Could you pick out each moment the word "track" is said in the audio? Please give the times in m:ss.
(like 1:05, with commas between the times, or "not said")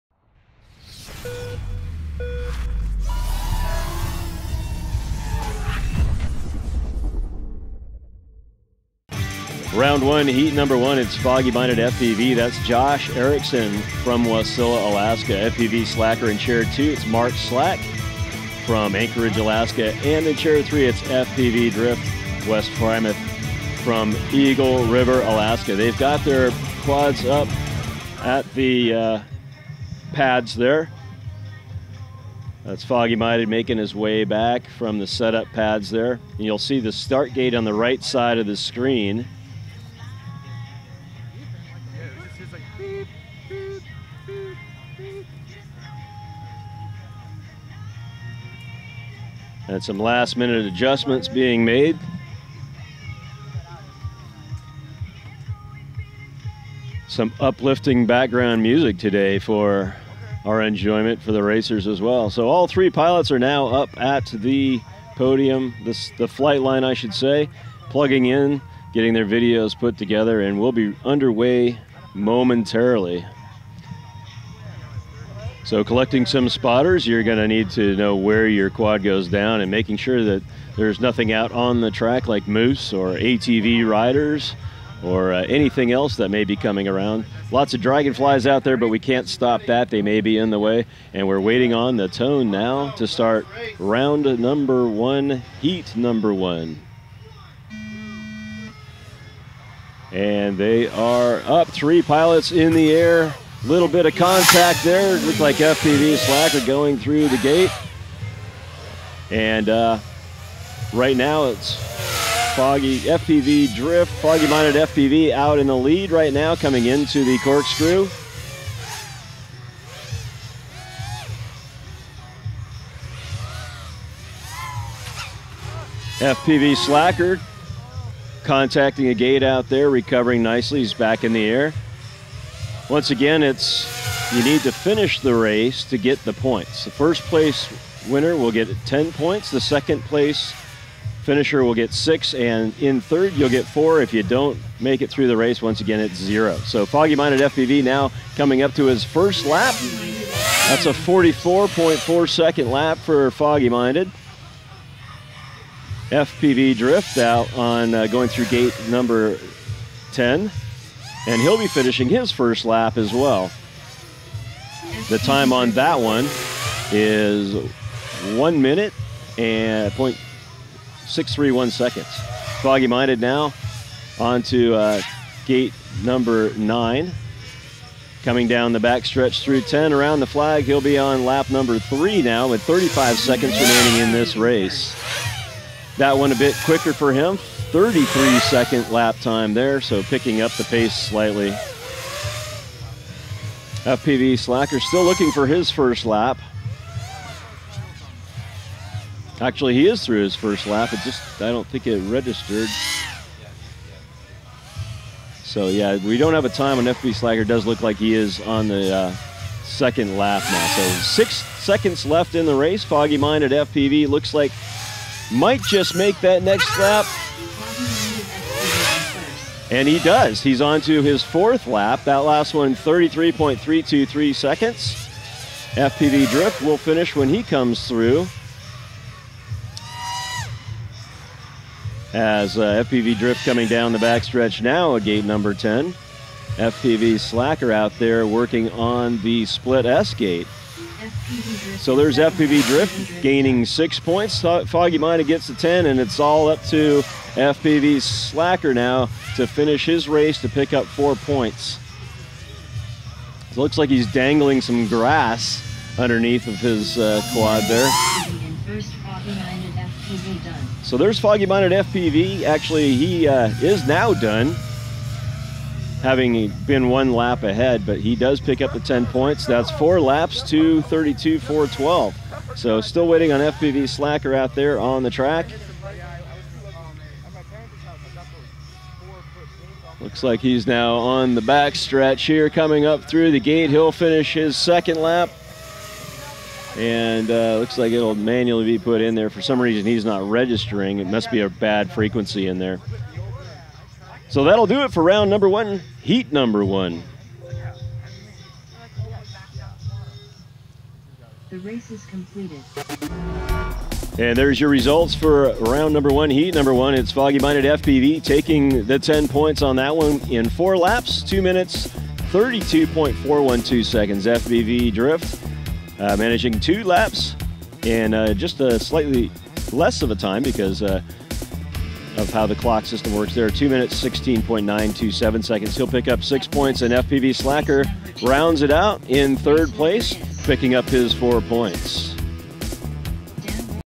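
1:21, 4:35.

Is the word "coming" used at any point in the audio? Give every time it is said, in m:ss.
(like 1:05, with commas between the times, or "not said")
1:26, 1:56, 2:28, 2:58, 3:53, 4:42.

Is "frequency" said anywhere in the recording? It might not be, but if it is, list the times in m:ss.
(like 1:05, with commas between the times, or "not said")
4:51.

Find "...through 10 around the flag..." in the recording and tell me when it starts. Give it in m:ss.
2:59.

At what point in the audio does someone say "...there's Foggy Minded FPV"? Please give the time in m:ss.
4:20.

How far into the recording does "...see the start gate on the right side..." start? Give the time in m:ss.
0:36.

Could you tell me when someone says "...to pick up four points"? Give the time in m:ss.
4:10.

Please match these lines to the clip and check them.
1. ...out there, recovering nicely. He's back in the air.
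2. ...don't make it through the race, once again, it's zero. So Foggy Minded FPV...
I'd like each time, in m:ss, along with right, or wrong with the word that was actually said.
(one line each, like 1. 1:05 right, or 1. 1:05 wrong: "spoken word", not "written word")
1. 2:09 right
2. 2:24 right.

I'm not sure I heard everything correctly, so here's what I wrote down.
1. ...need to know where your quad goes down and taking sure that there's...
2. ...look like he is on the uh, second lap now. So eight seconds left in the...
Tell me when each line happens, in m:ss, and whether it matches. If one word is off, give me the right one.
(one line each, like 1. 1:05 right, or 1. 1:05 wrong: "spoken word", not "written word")
1. 1:17 wrong: "making", not "taking"
2. 3:27 wrong: "six", not "eight".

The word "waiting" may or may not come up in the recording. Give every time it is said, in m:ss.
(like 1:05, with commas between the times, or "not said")
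1:31, 4:33.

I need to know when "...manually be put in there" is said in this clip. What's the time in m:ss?
4:48.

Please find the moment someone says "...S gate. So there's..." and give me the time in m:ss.
3:59.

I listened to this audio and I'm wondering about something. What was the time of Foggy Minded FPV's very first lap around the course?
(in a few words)
44.4 seconds.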